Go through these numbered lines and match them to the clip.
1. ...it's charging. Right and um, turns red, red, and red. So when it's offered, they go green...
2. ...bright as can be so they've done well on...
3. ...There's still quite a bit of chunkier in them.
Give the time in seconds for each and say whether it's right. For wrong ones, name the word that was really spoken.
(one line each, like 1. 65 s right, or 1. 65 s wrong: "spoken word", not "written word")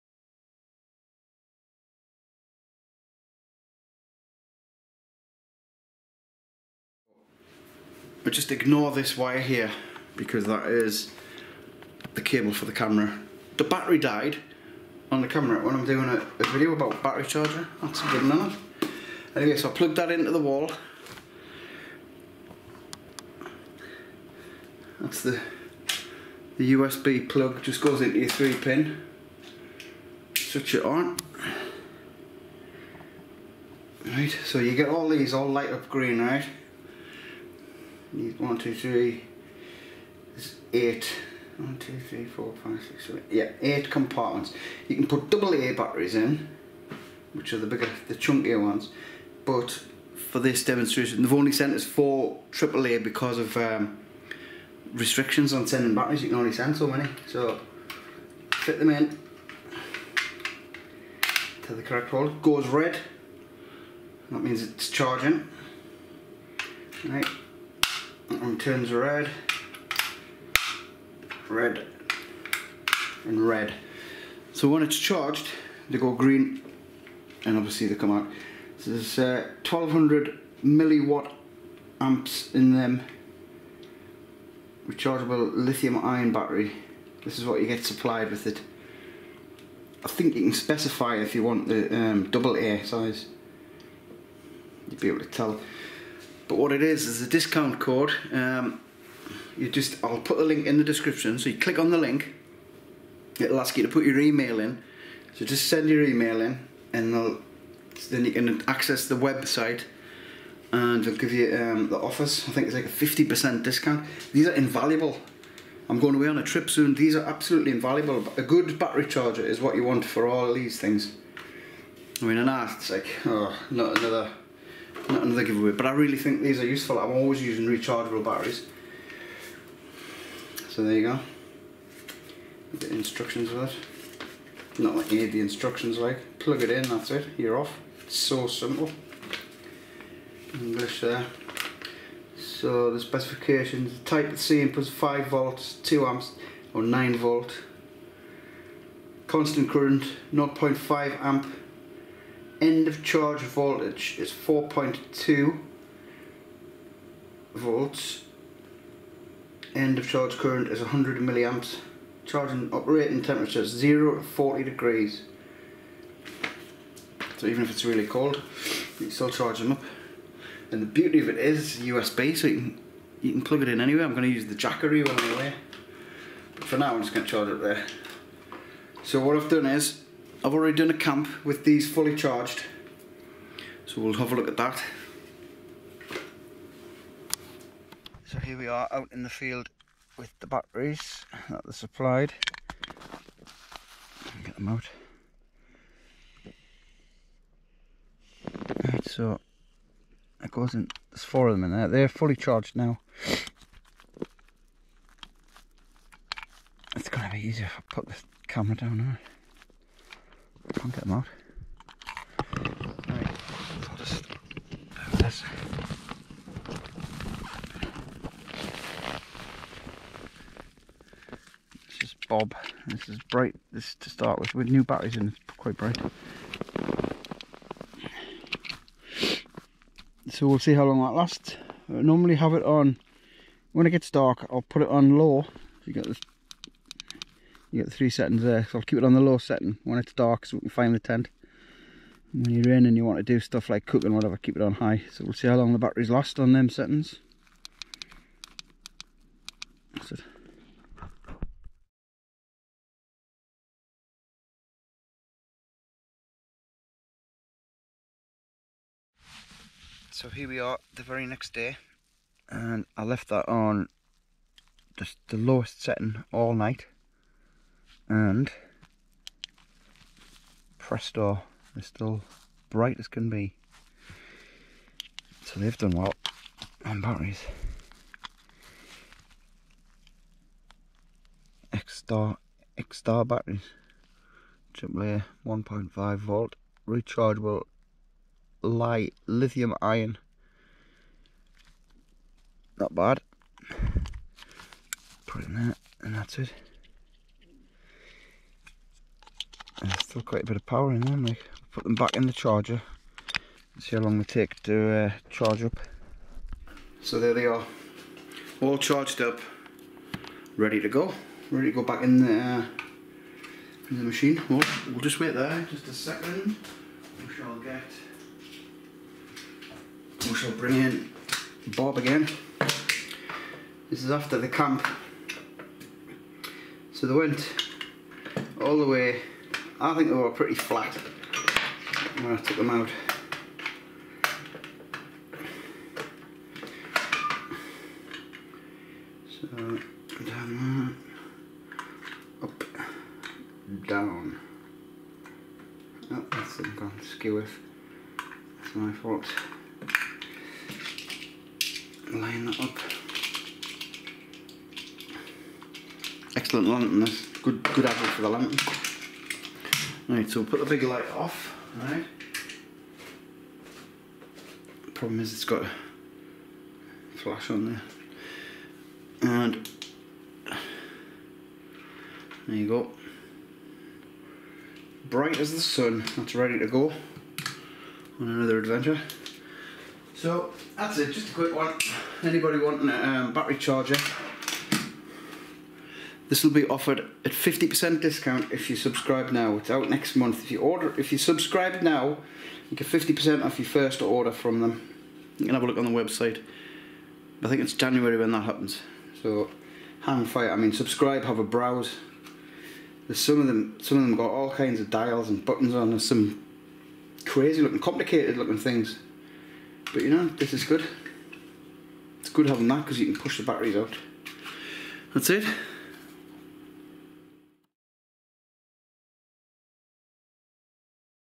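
1. 64 s wrong: "charged", not "offered"
2. 272 s right
3. 299 s wrong: "power", not "chunkier".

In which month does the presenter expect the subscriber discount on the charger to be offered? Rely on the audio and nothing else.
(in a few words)
January.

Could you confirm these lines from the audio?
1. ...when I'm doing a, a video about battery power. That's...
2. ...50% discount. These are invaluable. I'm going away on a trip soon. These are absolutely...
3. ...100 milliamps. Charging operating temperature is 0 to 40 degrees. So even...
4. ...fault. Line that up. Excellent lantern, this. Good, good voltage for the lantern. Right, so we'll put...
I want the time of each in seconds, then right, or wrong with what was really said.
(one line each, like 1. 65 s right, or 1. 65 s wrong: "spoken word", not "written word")
1. 15 s wrong: "charger", not "power"
2. 112 s right
3. 160 s right
4. 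348 s wrong: "average", not "voltage".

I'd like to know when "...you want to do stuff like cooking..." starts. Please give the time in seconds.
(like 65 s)
242 s.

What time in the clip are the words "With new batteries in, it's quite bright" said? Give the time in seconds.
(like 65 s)
224 s.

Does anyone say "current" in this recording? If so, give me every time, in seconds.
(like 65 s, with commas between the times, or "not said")
149 s, 160 s.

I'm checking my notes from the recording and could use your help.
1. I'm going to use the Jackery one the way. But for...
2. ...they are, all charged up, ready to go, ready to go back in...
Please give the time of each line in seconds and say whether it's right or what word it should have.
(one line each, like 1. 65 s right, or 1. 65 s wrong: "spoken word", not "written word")
1. 174 s right
2. 307 s right.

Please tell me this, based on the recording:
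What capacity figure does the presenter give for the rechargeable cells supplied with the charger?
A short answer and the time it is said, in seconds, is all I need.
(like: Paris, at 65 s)
1200 milliwatt amps, at 79 s.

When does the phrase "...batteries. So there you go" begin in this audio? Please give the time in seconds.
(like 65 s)
128 s.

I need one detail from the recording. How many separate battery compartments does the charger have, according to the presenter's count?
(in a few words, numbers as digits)
8.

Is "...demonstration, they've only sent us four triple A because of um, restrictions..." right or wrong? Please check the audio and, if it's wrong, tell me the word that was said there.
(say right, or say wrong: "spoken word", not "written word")
right.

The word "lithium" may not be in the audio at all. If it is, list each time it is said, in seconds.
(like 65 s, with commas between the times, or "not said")
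85 s, 289 s.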